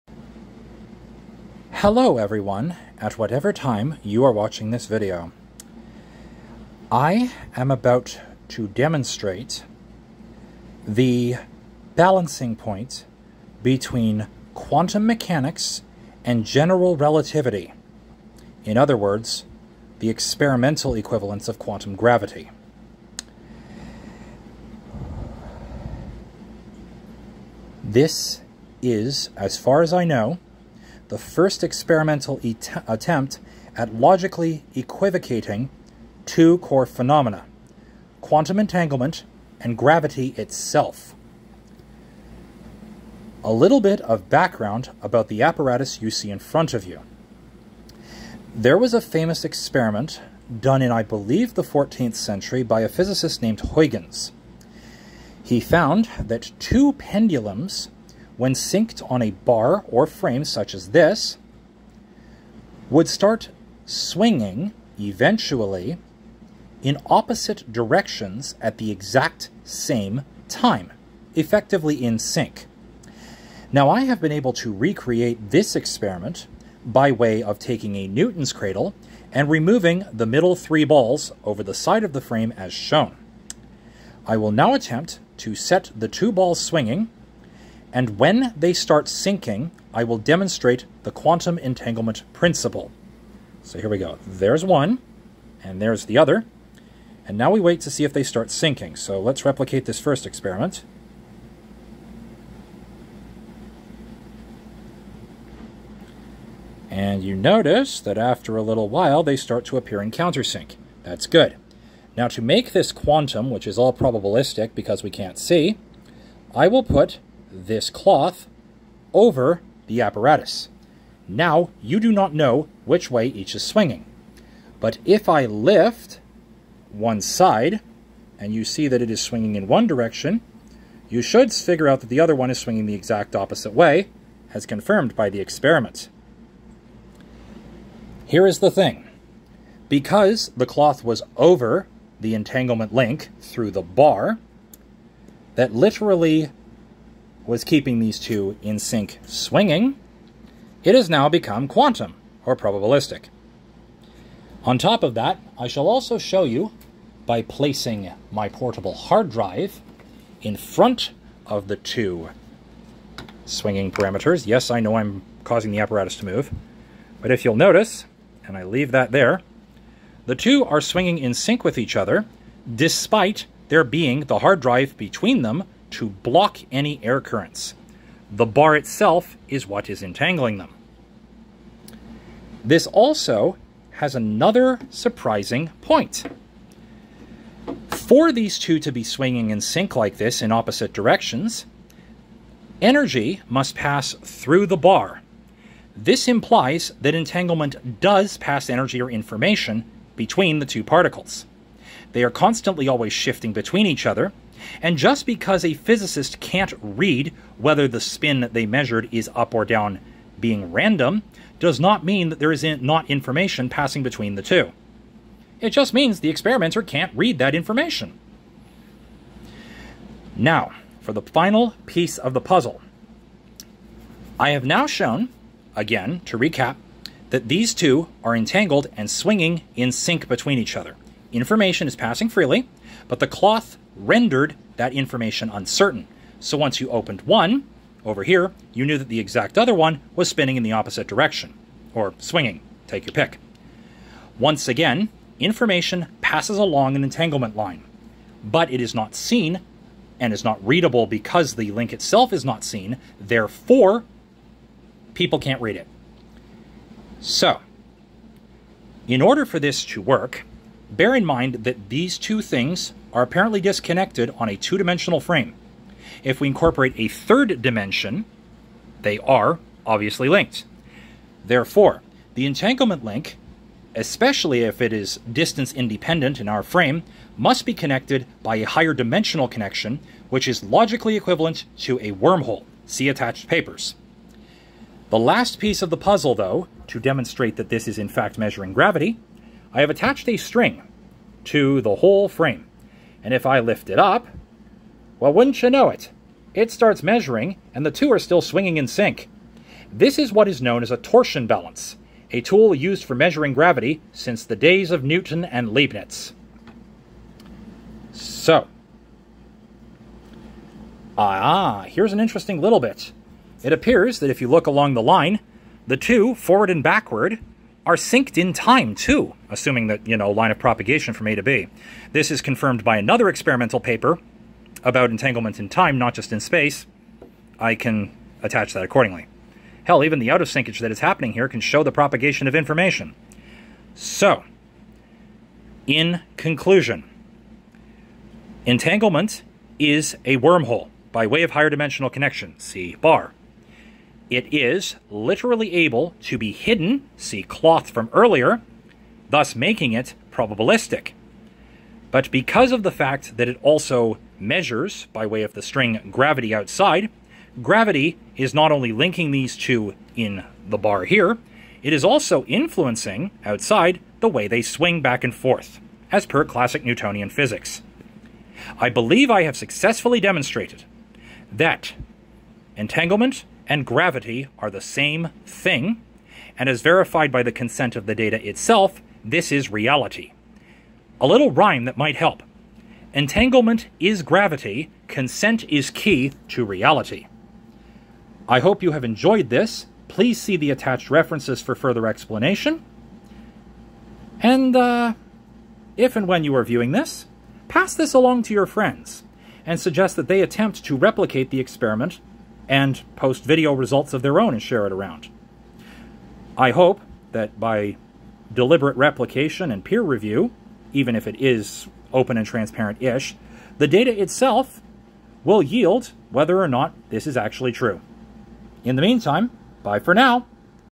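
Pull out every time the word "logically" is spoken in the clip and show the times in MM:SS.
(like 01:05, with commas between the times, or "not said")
00:33, 04:40.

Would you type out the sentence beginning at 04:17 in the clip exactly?
So, in order for this to work, Bear in mind that these two things are apparently disconnected on a two-dimensional frame.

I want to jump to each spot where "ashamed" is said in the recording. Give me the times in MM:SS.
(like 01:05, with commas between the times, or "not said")
not said.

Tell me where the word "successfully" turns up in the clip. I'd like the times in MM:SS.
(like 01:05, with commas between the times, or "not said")
06:09.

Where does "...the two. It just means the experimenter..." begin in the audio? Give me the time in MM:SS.
03:34.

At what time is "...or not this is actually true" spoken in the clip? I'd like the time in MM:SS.
06:56.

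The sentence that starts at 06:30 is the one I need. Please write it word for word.
Please see the attached references for further explanation.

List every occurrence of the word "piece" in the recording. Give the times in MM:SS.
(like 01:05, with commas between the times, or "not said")
03:41, 04:45.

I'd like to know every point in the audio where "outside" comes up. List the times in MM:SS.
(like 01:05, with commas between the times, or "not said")
05:56, 06:03.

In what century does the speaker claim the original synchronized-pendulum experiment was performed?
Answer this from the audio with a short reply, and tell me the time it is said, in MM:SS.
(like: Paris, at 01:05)
14th century, at 00:51.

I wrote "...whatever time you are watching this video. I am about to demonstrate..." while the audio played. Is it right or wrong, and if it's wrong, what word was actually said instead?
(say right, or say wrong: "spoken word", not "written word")
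right.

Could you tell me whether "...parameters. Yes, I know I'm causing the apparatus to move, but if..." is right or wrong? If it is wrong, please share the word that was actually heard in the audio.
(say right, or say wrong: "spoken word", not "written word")
right.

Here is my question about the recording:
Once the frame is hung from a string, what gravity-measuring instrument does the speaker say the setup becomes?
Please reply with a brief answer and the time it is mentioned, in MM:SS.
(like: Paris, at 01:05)
torsion balance, at 05:00.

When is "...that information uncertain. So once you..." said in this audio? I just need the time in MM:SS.
03:54.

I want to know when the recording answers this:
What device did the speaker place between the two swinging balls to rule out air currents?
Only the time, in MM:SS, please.
02:38.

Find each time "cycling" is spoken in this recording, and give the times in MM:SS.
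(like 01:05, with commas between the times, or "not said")
not said.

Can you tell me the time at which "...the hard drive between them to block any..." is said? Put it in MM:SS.
02:54.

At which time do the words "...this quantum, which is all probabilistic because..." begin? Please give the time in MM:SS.
01:52.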